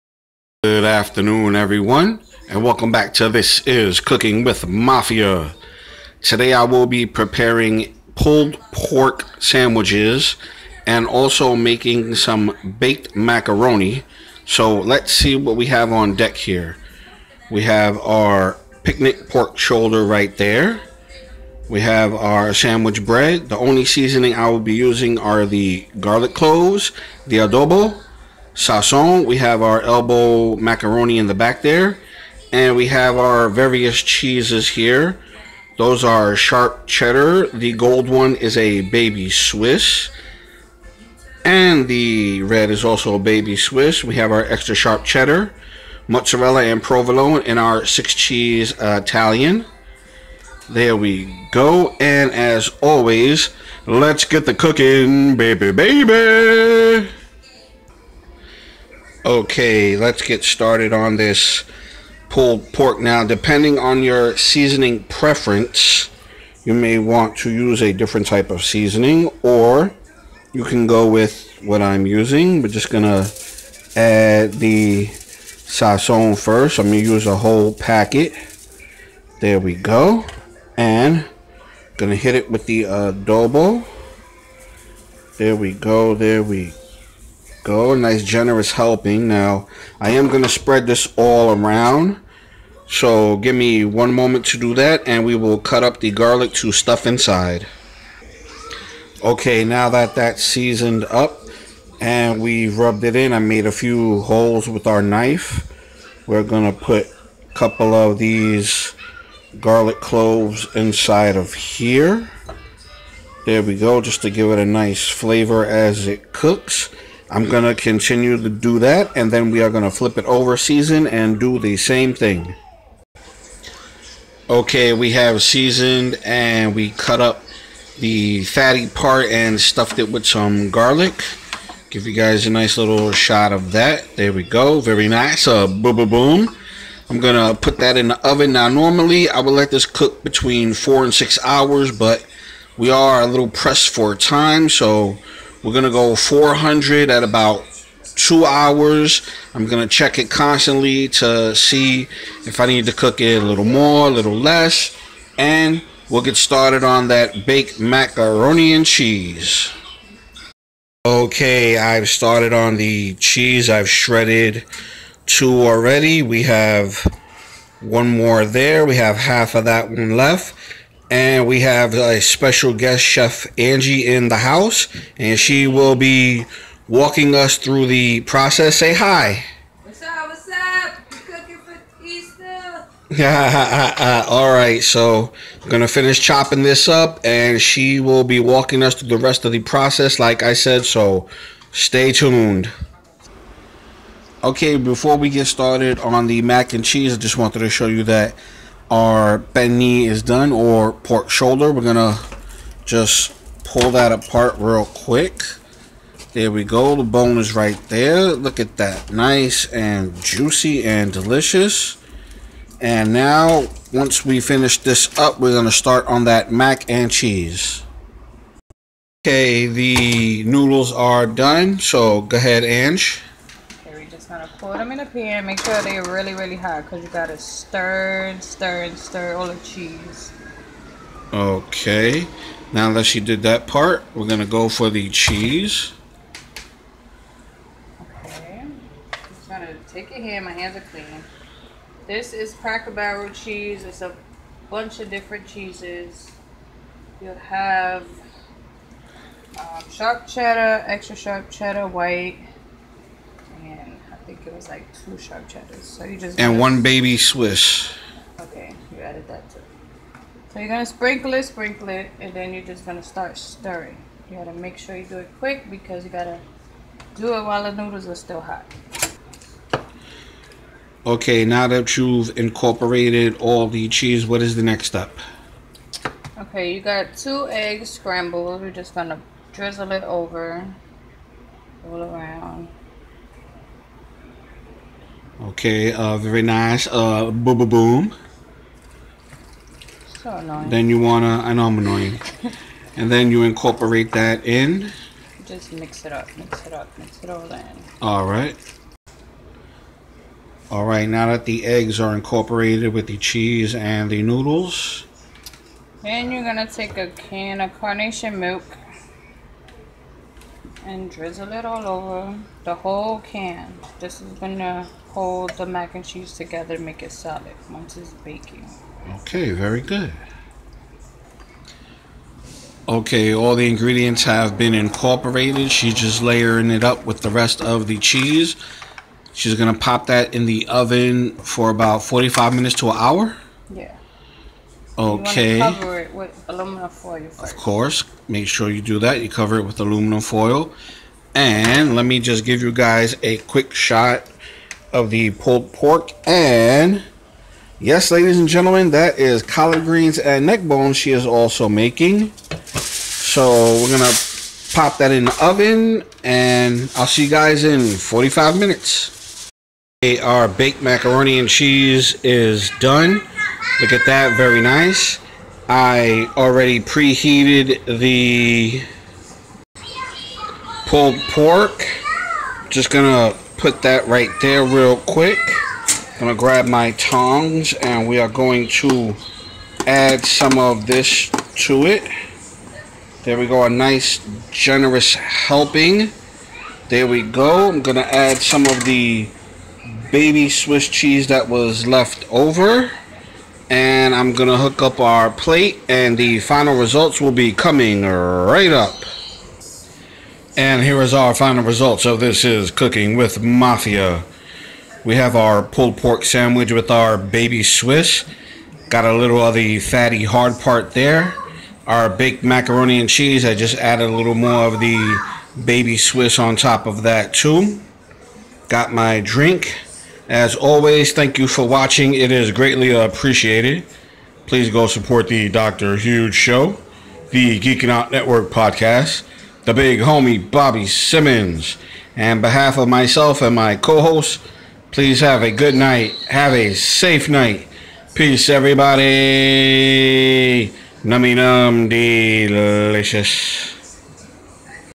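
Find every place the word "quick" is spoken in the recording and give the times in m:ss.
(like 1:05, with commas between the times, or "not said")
3:24, 4:25, 5:43, 6:14.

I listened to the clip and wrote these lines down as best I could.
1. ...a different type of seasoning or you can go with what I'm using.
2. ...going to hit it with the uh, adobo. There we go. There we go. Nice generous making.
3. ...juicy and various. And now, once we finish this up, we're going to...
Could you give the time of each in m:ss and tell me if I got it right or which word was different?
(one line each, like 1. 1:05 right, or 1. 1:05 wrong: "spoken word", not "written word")
1. 1:07 right
2. 1:21 wrong: "helping", not "making"
3. 3:30 wrong: "delicious", not "various".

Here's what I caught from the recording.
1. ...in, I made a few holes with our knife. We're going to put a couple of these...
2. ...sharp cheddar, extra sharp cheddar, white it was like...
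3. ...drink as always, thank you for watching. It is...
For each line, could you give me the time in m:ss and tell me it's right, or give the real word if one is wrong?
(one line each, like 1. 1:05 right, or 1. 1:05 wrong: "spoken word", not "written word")
1. 1:43 right
2. 4:09 right
3. 6:59 right.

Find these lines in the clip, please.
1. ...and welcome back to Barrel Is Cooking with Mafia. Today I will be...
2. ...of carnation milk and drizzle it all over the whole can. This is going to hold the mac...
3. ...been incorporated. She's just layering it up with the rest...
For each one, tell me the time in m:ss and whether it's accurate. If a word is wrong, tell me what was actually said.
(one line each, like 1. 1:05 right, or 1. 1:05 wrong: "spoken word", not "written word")
1. 0:02 wrong: "This", not "Barrel"
2. 5:07 right
3. 5:24 right.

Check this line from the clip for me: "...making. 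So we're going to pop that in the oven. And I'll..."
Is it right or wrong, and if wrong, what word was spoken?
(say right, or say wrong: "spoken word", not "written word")
right.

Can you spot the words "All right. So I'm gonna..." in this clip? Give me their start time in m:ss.
3:04.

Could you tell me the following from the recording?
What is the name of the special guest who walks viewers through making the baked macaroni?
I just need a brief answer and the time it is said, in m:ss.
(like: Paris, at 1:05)
Angie, at 2:53.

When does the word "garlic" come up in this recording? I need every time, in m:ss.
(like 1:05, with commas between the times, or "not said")
0:25, 1:36, 1:49, 2:10.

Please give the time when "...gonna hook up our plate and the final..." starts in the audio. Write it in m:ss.
6:34.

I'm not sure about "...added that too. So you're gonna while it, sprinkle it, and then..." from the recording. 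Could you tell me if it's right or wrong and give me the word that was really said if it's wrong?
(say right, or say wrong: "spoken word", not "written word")
wrong: "sprinkle", not "while".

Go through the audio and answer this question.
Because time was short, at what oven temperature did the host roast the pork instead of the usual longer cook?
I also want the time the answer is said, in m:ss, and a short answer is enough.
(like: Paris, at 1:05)
400, at 2:26.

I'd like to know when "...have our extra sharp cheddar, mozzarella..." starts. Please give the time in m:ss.
0:44.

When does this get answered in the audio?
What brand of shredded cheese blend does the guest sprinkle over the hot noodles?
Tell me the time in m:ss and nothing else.
4:02.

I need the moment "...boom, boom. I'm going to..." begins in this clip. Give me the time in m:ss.
2:15.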